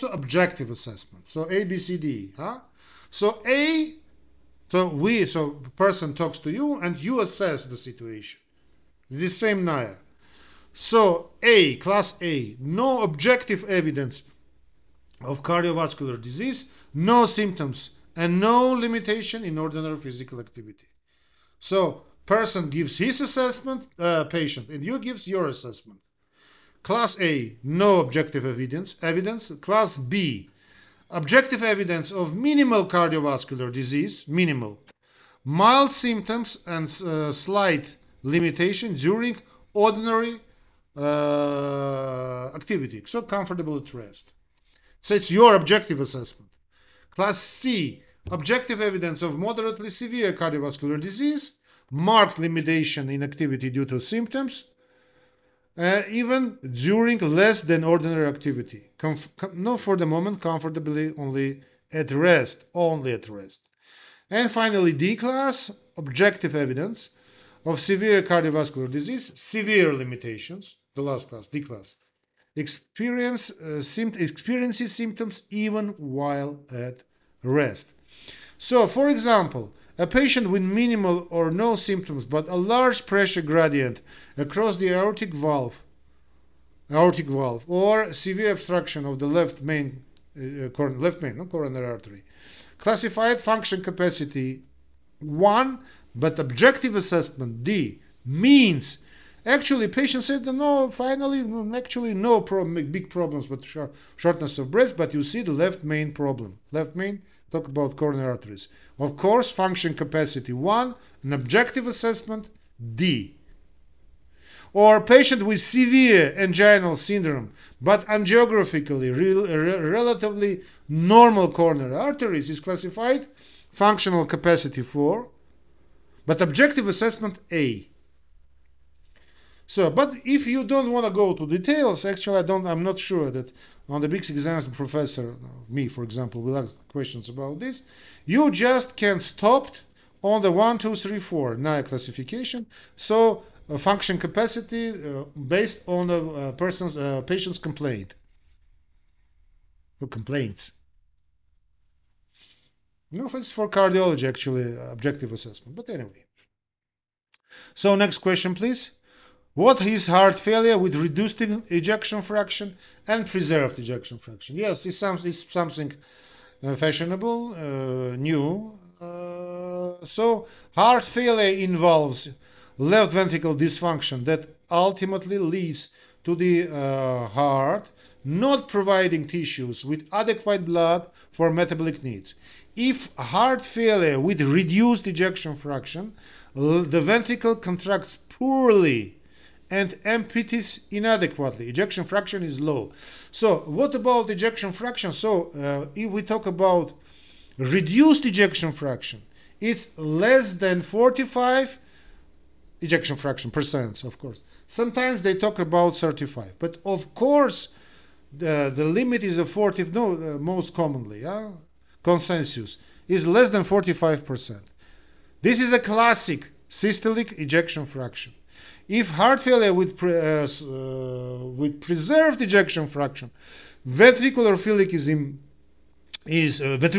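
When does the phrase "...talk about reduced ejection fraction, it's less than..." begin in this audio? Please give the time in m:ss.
3:16.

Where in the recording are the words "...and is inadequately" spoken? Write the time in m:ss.
3:09.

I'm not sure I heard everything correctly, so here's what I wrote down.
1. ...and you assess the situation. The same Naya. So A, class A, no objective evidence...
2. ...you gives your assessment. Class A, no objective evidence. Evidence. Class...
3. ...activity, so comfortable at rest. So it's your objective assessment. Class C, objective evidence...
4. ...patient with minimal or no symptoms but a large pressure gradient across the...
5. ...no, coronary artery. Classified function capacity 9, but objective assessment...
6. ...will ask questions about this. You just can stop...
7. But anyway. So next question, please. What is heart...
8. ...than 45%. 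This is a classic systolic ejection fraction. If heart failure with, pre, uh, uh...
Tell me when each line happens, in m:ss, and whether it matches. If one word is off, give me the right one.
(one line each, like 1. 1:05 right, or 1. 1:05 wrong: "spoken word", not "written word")
1. 0:06 right
2. 0:24 right
3. 0:42 right
4. 1:20 right
5. 1:31 wrong: "1", not "9"
6. 2:16 right
7. 2:35 right
8. 3:33 right.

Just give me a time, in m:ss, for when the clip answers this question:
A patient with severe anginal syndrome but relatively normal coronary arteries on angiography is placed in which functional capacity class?
2:03.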